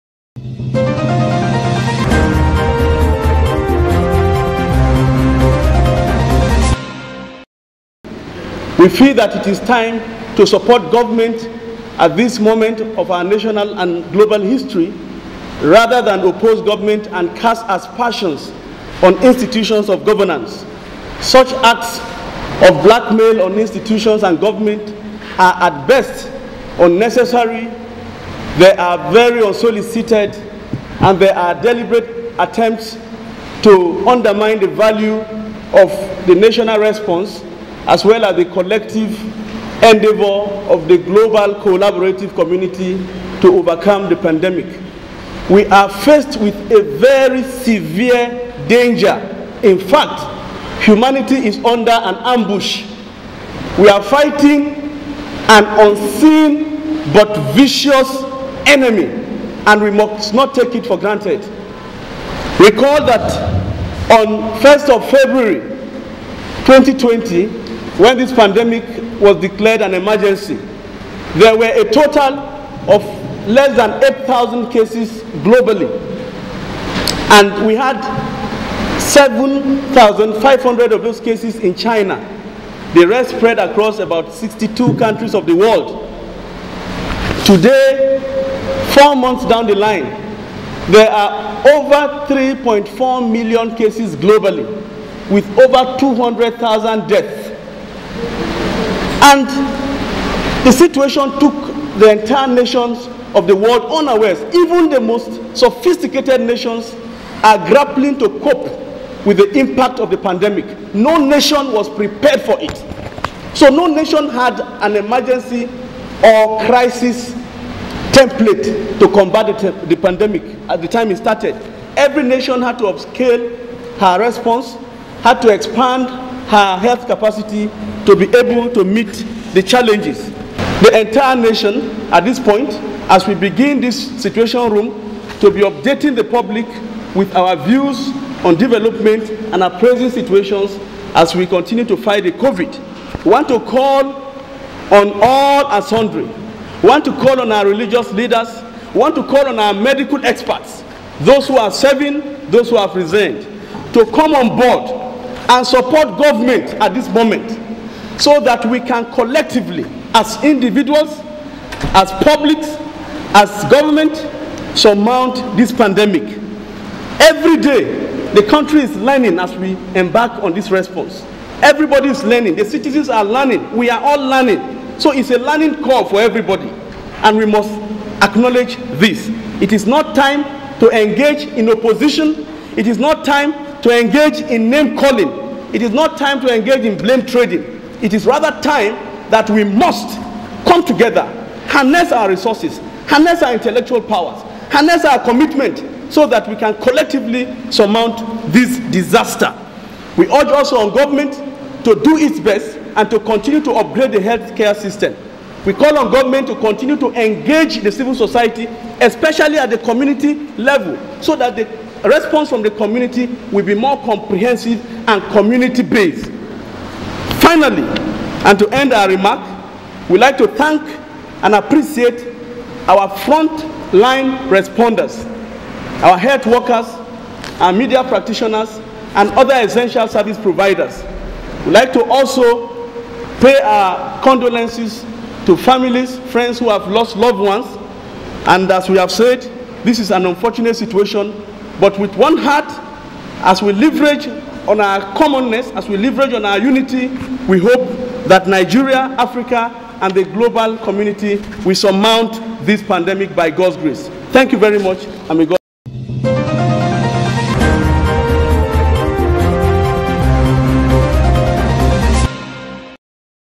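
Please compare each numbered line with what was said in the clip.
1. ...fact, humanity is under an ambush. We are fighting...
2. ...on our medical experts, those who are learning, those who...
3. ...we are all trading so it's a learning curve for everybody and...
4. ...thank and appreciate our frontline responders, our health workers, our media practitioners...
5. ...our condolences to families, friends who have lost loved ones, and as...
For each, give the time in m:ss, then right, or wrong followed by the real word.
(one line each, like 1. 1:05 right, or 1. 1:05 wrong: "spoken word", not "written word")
1. 0:49 right
2. 2:29 wrong: "serving", not "learning"
3. 2:53 wrong: "learning", not "trading"
4. 3:40 right
5. 3:53 right.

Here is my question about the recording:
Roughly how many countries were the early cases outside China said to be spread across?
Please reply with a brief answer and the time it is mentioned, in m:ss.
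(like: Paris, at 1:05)
62, at 1:24.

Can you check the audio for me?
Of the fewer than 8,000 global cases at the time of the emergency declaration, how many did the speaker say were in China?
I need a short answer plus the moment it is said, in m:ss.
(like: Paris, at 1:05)
7,500, at 1:18.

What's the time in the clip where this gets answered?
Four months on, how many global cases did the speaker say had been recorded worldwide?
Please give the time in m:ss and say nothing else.
1:31.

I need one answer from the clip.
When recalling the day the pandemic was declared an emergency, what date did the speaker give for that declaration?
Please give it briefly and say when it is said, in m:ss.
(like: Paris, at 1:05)
1 February 2020, at 1:04.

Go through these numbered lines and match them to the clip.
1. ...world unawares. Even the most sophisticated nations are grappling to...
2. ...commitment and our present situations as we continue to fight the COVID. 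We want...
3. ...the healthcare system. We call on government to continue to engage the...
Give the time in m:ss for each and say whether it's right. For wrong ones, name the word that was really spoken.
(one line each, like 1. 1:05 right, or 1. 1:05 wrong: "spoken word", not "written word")
1. 1:43 right
2. 2:18 wrong: "development", not "commitment"
3. 3:24 right.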